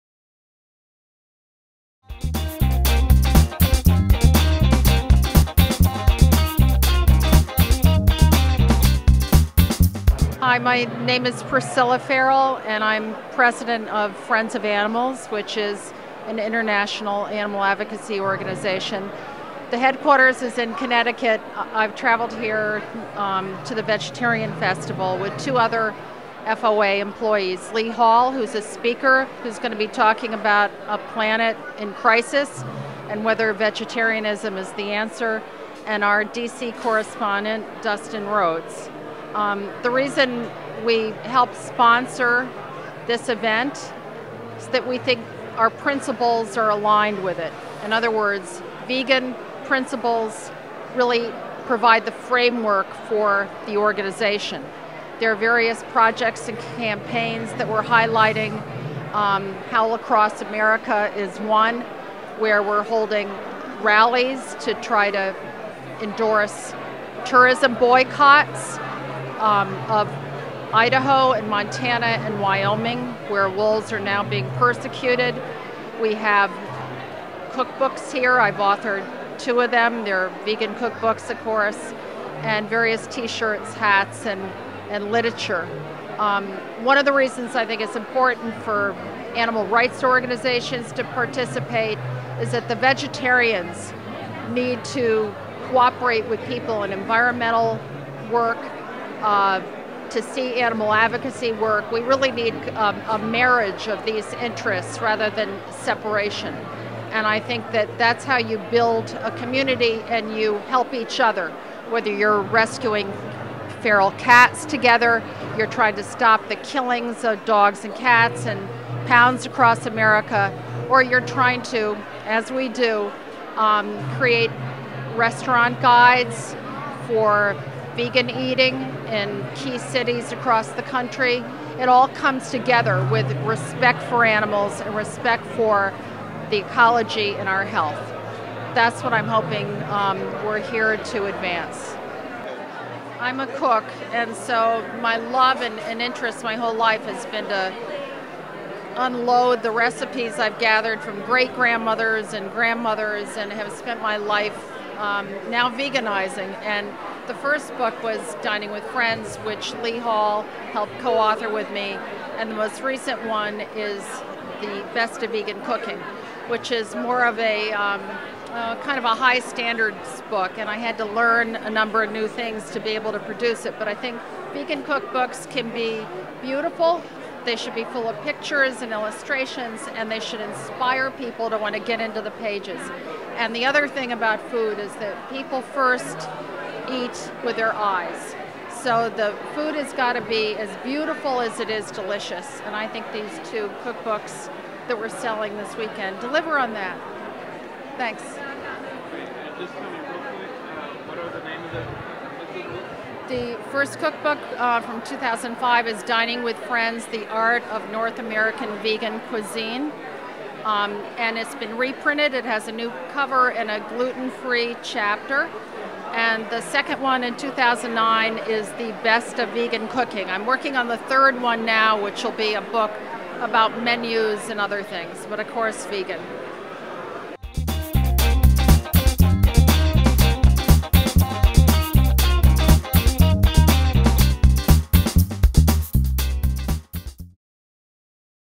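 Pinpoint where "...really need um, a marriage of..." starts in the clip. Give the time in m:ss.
1:42.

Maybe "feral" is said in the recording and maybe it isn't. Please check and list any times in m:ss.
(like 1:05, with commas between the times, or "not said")
0:11, 1:53.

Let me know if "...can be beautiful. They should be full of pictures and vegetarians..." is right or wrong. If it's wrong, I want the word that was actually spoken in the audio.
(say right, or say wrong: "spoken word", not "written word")
wrong: "illustrations", not "vegetarians".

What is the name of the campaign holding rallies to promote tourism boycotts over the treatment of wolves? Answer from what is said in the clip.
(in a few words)
Howl Across America.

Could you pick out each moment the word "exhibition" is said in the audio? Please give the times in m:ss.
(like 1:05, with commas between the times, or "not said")
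not said.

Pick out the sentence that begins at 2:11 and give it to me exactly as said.
It all comes together with respect for animals and respect for the ecology and our health.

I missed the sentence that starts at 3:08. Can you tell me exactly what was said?
So the food has got to be as beautiful as it is delicious.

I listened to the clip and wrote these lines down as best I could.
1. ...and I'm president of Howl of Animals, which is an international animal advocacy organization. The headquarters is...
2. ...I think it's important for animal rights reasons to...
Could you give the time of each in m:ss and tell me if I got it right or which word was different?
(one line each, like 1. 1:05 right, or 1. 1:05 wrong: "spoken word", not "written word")
1. 0:12 wrong: "Friends", not "Howl"
2. 1:27 wrong: "organizations", not "reasons".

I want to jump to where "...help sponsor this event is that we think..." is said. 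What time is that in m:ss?
0:41.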